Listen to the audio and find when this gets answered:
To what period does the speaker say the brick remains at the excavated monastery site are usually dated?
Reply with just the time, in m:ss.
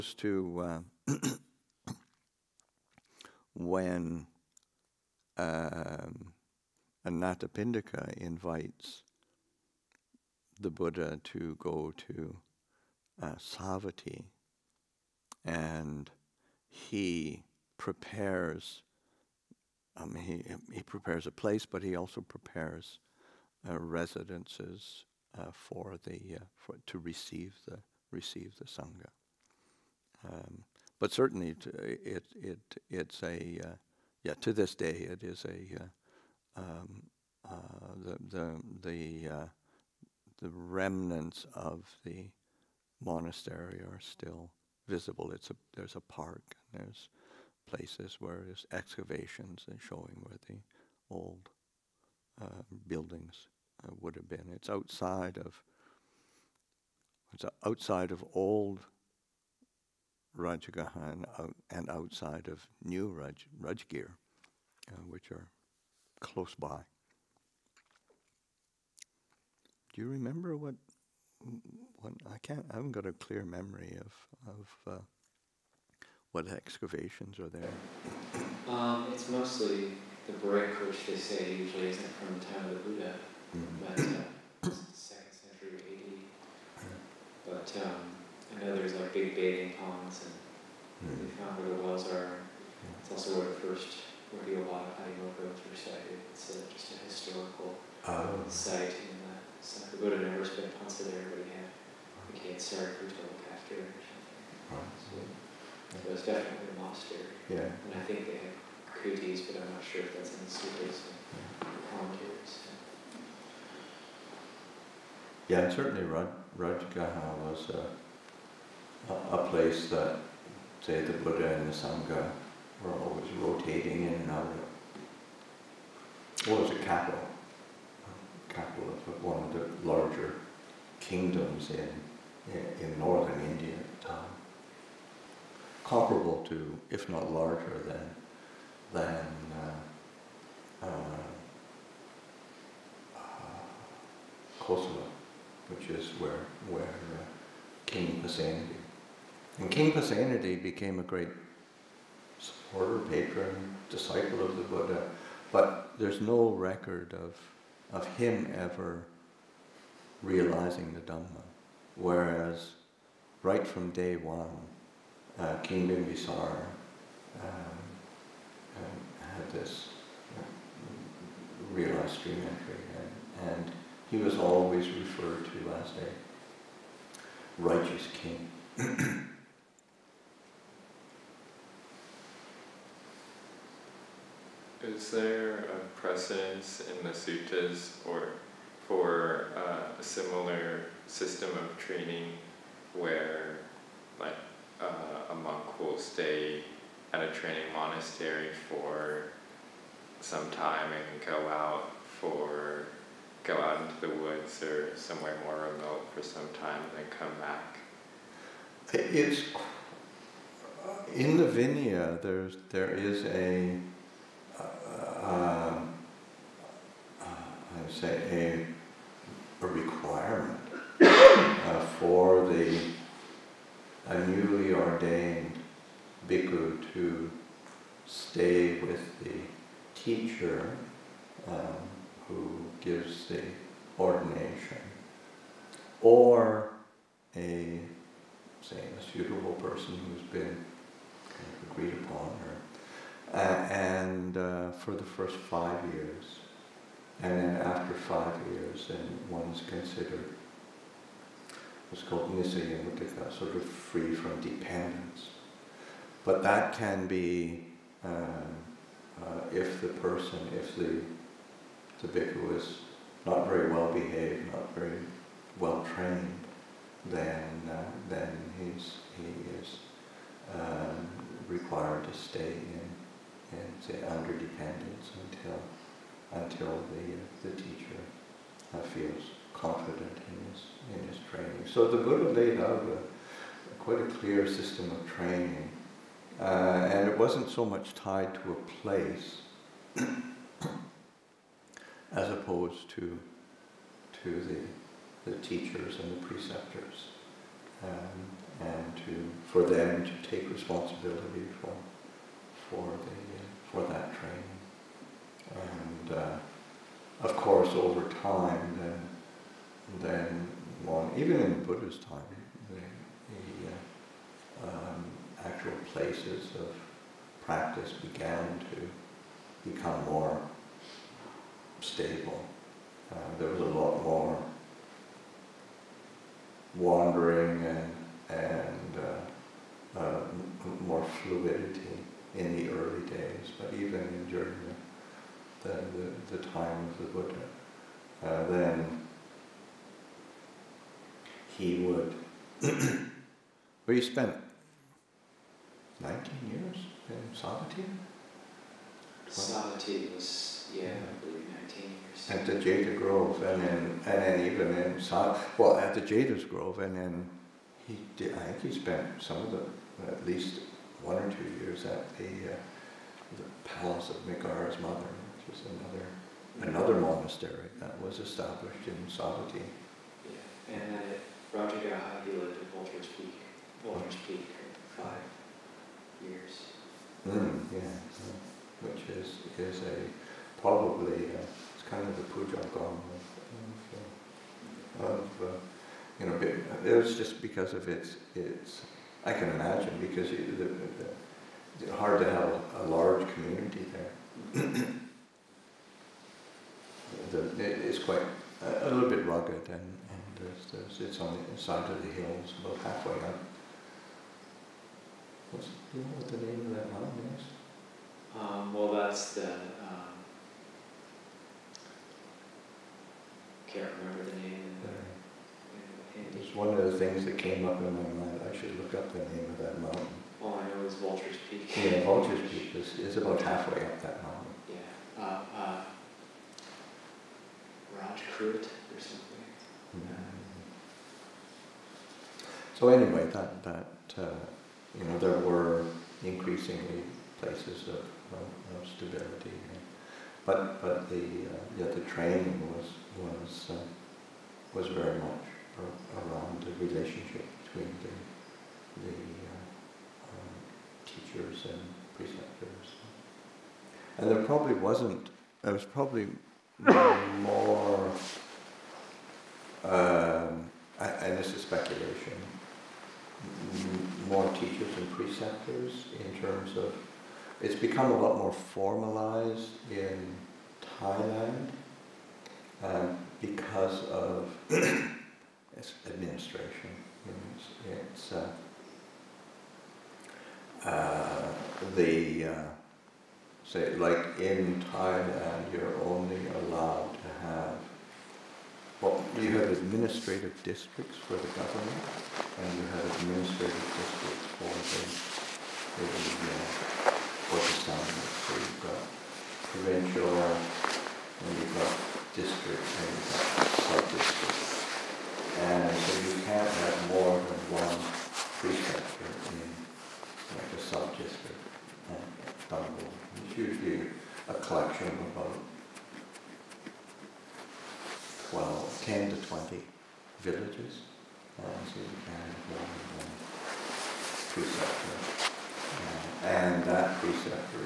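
1:24.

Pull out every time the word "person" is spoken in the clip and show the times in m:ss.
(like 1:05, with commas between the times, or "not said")
3:59, 4:20.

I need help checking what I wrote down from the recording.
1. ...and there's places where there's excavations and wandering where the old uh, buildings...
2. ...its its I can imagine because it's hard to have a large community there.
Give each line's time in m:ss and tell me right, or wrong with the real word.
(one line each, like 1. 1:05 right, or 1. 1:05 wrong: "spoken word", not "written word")
1. 0:46 wrong: "showing", not "wandering"
2. 6:27 right.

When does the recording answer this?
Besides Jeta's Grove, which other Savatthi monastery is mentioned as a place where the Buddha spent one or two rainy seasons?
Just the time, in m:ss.
6:03.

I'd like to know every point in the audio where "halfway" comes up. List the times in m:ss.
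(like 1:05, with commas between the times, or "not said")
6:42, 7:03.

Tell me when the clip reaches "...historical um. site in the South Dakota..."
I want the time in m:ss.
1:37.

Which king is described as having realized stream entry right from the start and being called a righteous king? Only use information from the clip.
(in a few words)
King Bimbisara.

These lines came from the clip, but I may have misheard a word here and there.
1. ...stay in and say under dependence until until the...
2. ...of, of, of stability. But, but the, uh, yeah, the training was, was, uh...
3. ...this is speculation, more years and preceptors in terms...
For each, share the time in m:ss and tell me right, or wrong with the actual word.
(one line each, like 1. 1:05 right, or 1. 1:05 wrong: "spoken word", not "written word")
1. 4:32 right
2. 7:17 right
3. 7:41 wrong: "teachers", not "years".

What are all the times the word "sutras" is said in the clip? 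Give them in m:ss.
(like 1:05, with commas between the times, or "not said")
1:50.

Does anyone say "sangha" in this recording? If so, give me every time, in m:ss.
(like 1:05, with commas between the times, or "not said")
0:28, 2:01.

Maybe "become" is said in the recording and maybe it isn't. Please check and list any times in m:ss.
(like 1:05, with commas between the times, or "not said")
5:19, 7:47.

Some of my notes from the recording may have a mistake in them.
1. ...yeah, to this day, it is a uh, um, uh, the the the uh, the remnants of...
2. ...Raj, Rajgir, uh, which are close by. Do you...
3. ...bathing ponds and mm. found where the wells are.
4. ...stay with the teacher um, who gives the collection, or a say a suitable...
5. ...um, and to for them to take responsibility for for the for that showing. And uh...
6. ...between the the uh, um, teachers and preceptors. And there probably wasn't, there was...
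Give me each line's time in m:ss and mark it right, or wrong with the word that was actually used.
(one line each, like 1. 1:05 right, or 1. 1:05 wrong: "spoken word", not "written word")
1. 0:34 right
2. 1:03 right
3. 1:29 right
4. 3:48 wrong: "ordination", not "collection"
5. 4:57 wrong: "training", not "showing"
6. 7:27 right.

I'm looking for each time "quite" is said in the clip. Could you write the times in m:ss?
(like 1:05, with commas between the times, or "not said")
4:43, 6:37.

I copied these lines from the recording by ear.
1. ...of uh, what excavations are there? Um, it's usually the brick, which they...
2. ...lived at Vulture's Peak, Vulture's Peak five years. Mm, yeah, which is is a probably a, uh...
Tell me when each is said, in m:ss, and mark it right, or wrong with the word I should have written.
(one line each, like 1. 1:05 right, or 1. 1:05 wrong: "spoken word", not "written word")
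1. 1:14 wrong: "mostly", not "usually"
2. 6:12 right.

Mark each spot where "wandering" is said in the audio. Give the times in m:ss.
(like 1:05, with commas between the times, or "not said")
5:26.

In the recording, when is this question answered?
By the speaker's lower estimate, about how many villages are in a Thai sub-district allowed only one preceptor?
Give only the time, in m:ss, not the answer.
8:39.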